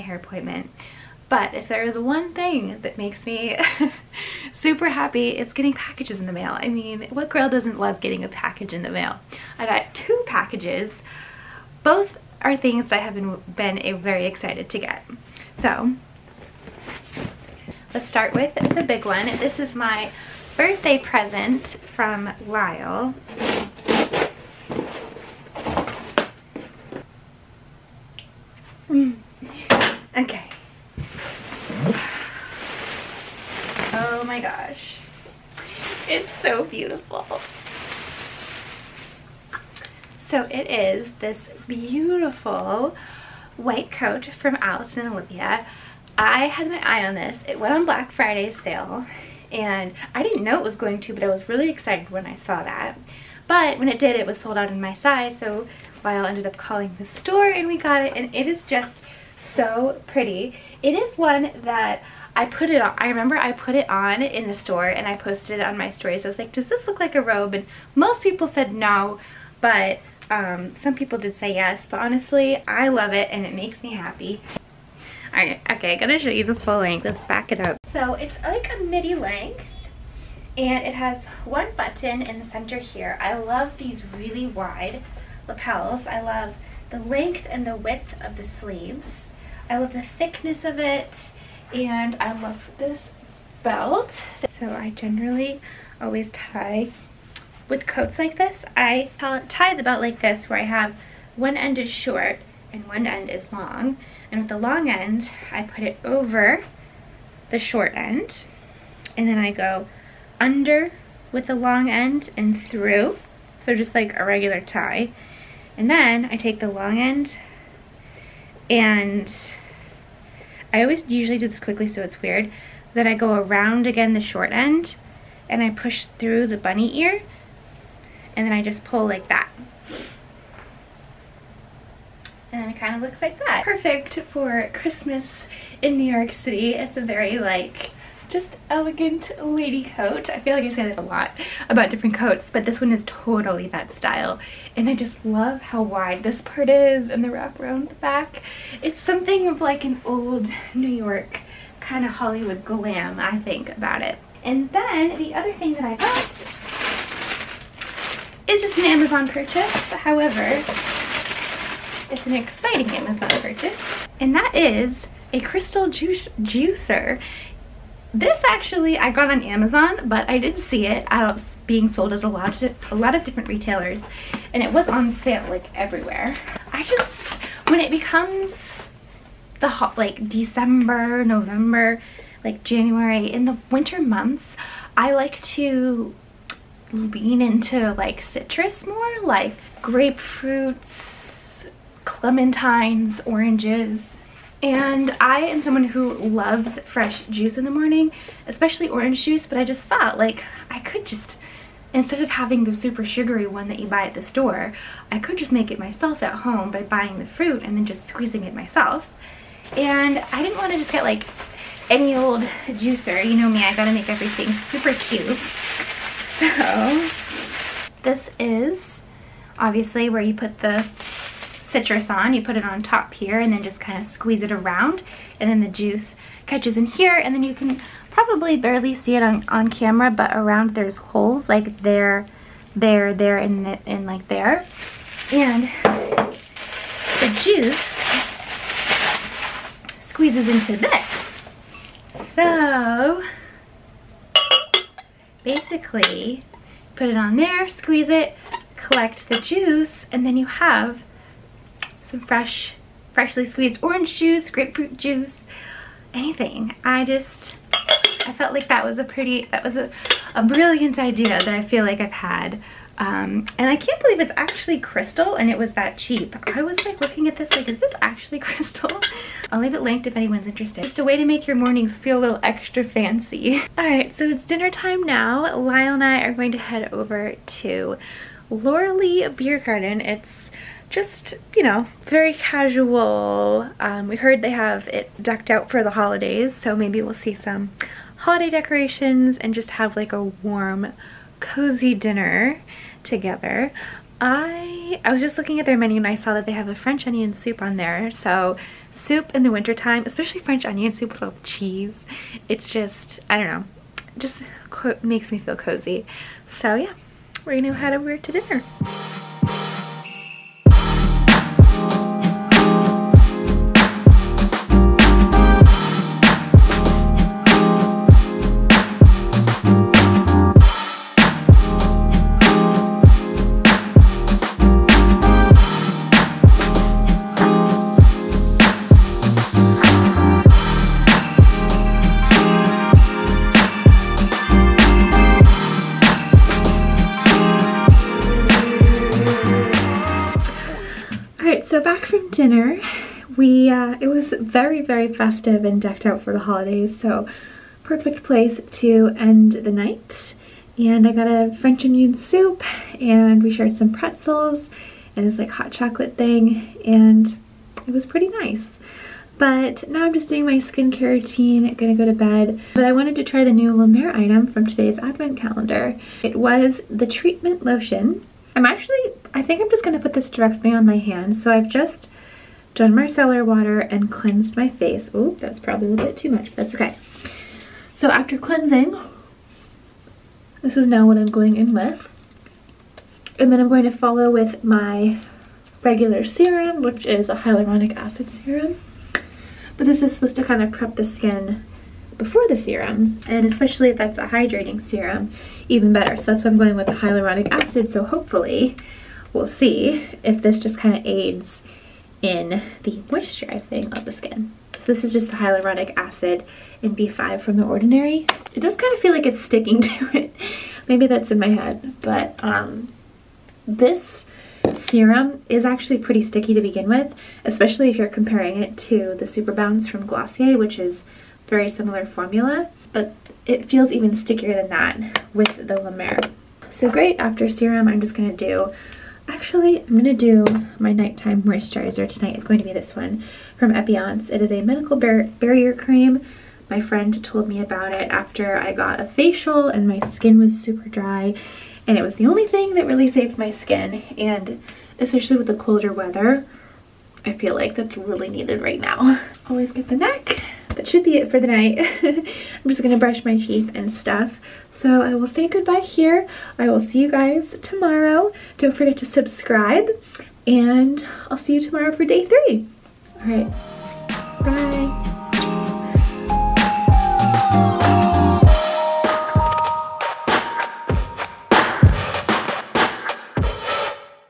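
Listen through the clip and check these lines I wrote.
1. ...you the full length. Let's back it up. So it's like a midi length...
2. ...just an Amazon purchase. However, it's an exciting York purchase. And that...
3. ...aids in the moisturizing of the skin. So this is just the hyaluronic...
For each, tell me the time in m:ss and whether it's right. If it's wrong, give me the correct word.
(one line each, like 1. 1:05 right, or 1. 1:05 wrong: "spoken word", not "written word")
1. 1:16 right
2. 2:38 wrong: "Amazon", not "York"
3. 6:41 right.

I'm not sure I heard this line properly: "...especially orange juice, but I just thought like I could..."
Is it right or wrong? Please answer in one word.
right.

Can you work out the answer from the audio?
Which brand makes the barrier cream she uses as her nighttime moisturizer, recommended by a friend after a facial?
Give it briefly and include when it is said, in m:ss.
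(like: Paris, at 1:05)
Epionce, at 7:13.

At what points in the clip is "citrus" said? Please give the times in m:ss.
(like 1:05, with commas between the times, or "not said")
3:08, 3:41.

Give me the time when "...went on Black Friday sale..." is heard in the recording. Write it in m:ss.
0:47.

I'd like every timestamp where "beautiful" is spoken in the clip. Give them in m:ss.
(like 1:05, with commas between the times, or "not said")
0:36, 0:41.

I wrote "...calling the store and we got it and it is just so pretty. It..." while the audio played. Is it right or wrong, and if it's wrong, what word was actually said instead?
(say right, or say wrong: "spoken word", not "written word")
right.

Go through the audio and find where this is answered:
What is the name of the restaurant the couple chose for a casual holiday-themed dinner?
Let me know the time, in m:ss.
4:38.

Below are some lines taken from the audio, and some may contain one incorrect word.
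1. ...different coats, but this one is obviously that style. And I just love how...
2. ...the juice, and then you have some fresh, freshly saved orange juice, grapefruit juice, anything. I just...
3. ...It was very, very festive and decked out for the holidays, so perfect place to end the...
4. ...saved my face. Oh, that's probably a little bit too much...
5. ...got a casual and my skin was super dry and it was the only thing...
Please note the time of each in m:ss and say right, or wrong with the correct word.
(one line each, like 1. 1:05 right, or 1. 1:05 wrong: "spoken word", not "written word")
1. 2:21 wrong: "totally", not "obviously"
2. 4:09 wrong: "squeezed", not "saved"
3. 5:43 right
4. 6:14 wrong: "cleansed", not "saved"
5. 7:18 wrong: "facial", not "casual".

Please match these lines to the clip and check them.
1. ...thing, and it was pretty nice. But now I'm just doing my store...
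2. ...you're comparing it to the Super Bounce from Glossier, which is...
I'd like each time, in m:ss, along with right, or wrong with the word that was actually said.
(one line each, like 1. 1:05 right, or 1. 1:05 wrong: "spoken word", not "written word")
1. 5:56 wrong: "skincare", not "store"
2. 6:57 right.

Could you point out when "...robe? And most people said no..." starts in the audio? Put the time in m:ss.
1:07.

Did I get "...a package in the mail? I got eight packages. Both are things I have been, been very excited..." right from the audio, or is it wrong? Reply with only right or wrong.
wrong.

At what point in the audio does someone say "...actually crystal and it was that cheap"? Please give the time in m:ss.
4:24.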